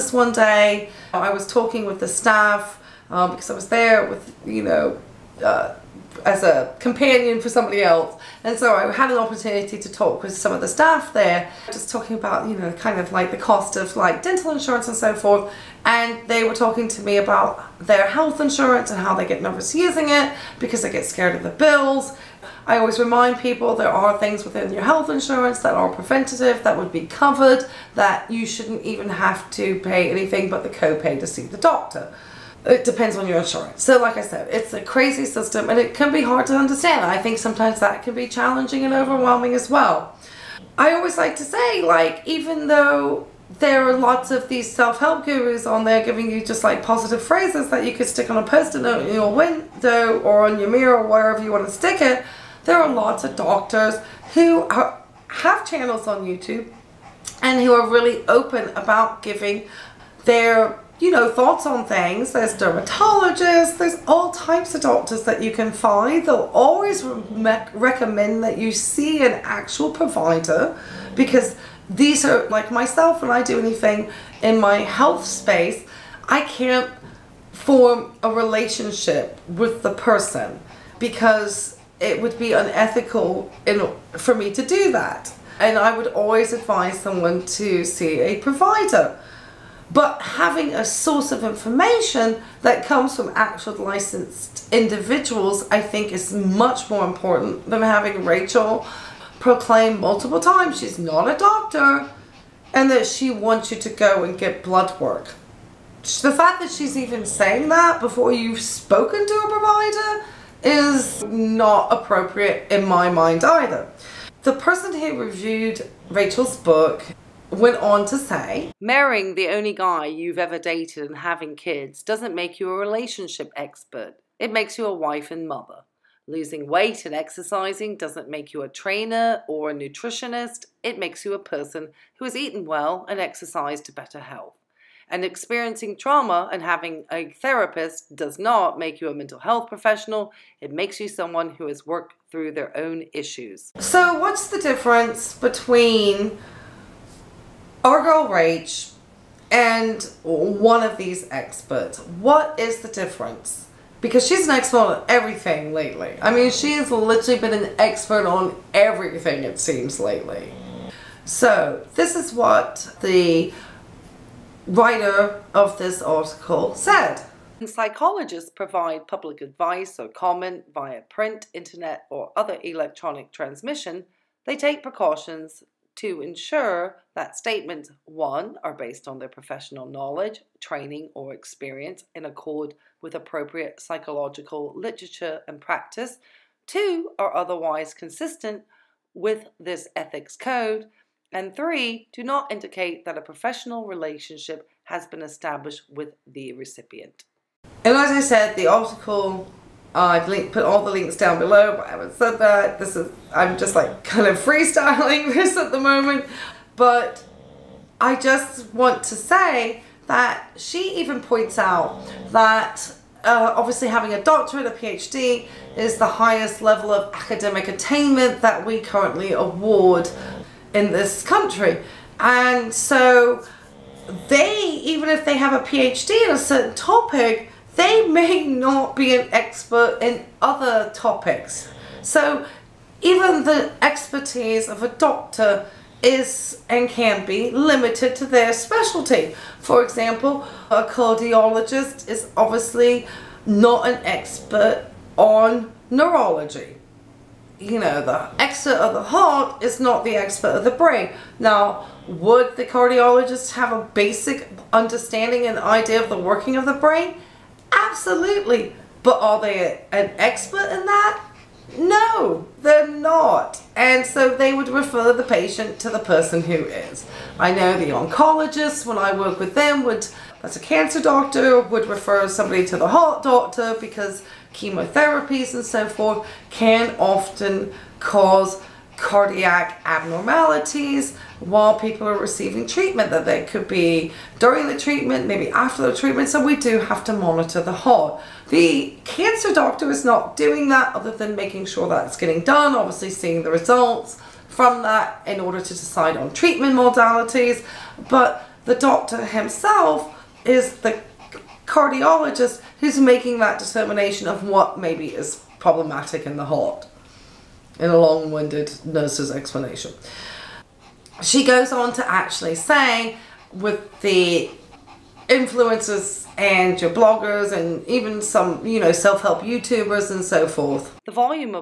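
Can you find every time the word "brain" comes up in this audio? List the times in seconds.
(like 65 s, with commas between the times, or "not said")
250 s, 256 s.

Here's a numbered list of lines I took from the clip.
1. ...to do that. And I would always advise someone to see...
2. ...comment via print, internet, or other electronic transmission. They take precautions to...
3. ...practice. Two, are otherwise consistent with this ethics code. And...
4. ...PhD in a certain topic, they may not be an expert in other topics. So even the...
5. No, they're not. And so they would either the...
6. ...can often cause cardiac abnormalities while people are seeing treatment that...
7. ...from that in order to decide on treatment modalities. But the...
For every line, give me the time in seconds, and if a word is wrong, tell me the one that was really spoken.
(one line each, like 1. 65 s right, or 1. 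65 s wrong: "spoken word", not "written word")
1. 84 s right
2. 170 s right
3. 185 s right
4. 225 s right
5. 261 s wrong: "refer", not "either"
6. 276 s wrong: "receiving", not "seeing"
7. 294 s right.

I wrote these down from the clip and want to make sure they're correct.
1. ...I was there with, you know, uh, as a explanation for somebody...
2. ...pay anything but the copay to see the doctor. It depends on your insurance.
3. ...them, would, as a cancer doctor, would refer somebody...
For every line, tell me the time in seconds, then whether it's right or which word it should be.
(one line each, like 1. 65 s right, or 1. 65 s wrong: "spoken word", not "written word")
1. 3 s wrong: "companion", not "explanation"
2. 29 s right
3. 269 s right.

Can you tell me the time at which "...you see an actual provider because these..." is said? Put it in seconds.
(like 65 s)
68 s.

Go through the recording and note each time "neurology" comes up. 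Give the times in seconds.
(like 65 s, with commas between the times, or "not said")
245 s.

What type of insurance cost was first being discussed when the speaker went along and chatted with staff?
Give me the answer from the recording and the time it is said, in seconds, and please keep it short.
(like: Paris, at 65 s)
dental insurance, at 14 s.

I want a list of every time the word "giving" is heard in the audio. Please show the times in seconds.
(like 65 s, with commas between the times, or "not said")
46 s, 59 s.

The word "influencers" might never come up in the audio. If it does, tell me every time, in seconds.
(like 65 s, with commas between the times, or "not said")
315 s.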